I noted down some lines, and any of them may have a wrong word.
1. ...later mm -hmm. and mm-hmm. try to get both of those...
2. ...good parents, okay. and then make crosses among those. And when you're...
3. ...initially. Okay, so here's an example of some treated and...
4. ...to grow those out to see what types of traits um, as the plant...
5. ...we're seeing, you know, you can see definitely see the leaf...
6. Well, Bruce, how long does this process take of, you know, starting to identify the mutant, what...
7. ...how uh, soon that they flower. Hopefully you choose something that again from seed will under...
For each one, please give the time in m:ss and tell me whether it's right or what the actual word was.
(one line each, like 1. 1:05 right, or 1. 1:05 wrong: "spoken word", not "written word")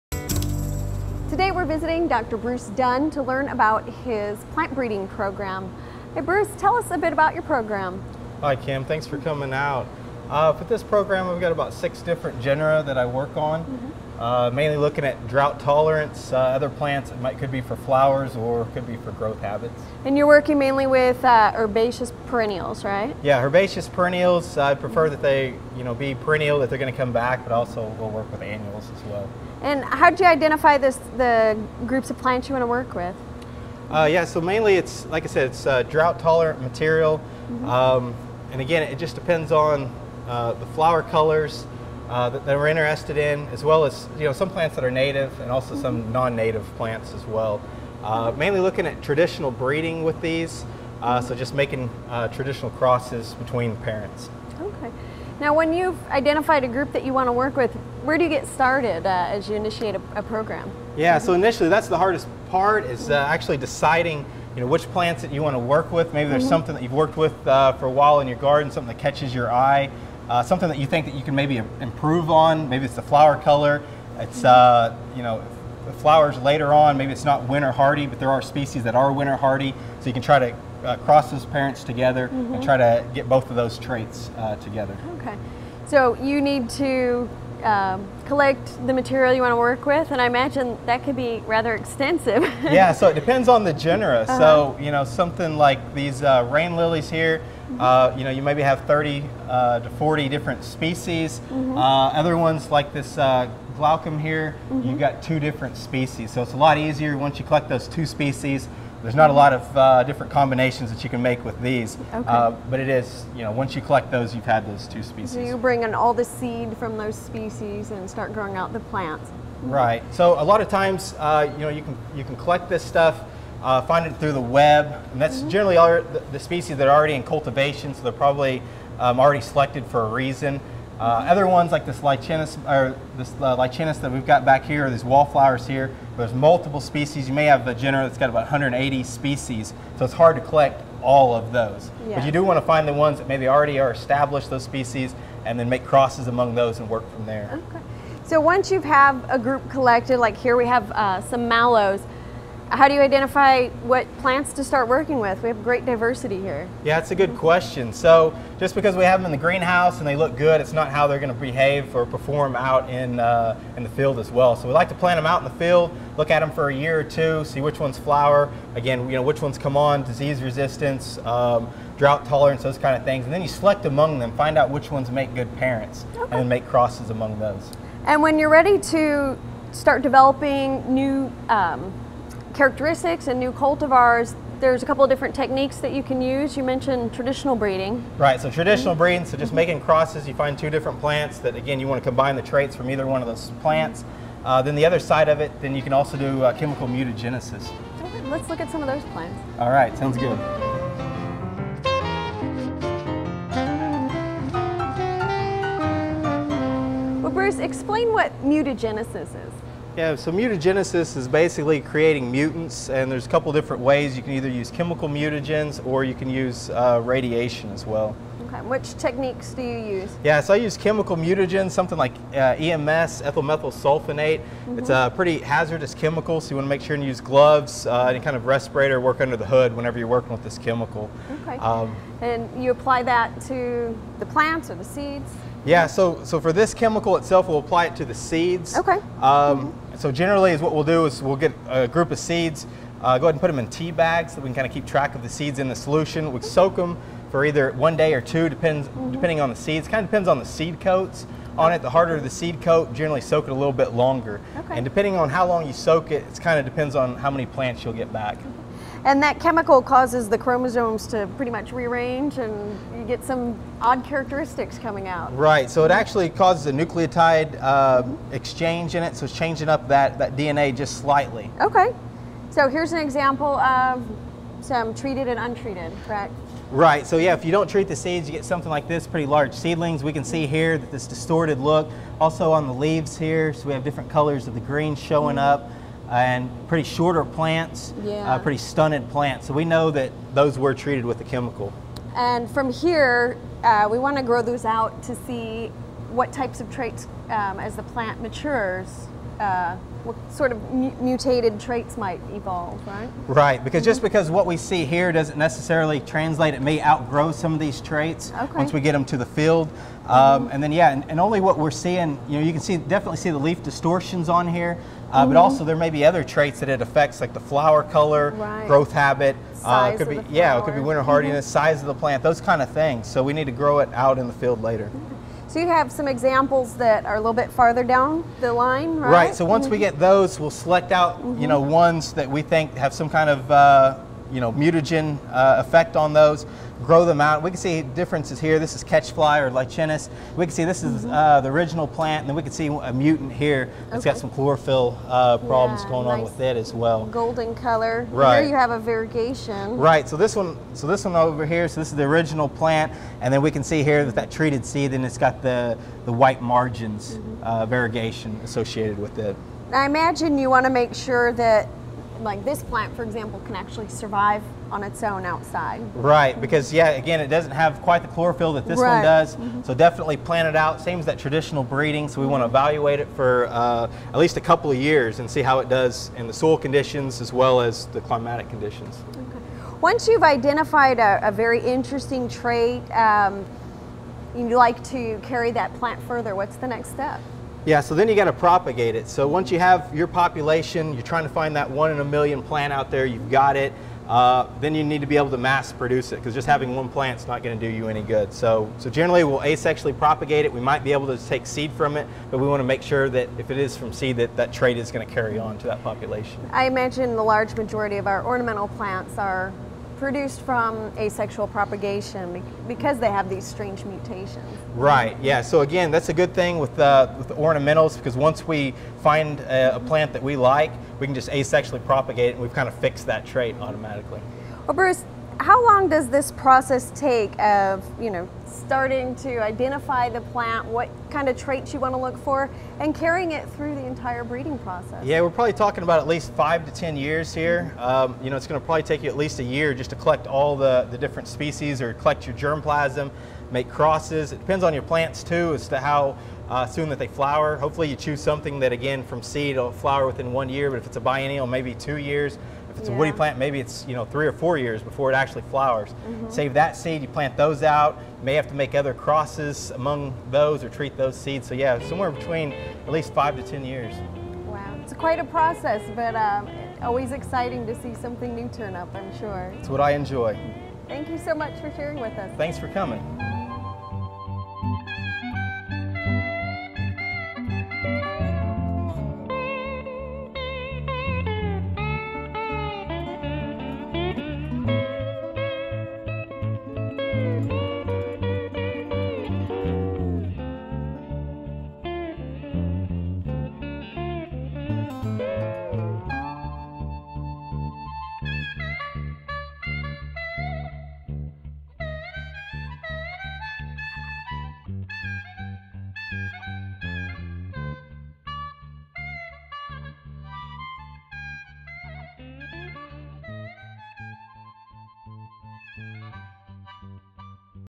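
1. 1:21 wrong: "together", not "later"
2. 2:55 right
3. 4:31 wrong: "slightly", not "initially"
4. 4:54 right
5. 5:11 right
6. 7:04 wrong: "plant", not "mutant"
7. 7:25 wrong: "flower", not "under".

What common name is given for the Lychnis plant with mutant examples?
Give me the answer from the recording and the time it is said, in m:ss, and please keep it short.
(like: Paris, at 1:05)
catchfly, at 5:38.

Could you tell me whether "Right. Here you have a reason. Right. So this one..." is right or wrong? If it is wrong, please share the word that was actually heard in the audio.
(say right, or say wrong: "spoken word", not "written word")
wrong: "variegation", not "reason".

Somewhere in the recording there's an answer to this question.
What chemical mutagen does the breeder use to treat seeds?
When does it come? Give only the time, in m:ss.
3:43.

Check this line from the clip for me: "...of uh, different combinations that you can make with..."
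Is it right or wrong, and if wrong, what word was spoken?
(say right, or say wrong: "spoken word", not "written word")
right.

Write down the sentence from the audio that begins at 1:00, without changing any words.
Yeah, so initially that's the hardest part is uh, actually deciding you know which plants that you want to work with.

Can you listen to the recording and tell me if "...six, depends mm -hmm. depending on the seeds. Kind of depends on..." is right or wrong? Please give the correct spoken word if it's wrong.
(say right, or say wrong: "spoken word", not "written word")
wrong: "two", not "six".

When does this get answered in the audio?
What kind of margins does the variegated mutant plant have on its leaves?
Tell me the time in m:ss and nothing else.
5:56.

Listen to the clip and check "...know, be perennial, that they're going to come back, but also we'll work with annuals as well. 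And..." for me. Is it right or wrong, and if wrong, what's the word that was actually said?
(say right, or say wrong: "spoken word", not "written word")
right.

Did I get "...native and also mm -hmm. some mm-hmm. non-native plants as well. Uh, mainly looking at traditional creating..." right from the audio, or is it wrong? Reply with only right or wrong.
wrong.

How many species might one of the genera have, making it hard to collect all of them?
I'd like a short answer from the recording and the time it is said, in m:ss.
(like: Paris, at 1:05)
180, at 2:18.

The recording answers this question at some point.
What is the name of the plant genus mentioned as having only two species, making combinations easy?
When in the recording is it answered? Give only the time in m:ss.
1:43.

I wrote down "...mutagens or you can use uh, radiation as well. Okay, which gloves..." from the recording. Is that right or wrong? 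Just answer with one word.
wrong.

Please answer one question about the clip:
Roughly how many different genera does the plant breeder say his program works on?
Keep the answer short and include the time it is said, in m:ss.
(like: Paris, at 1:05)
6, at 0:11.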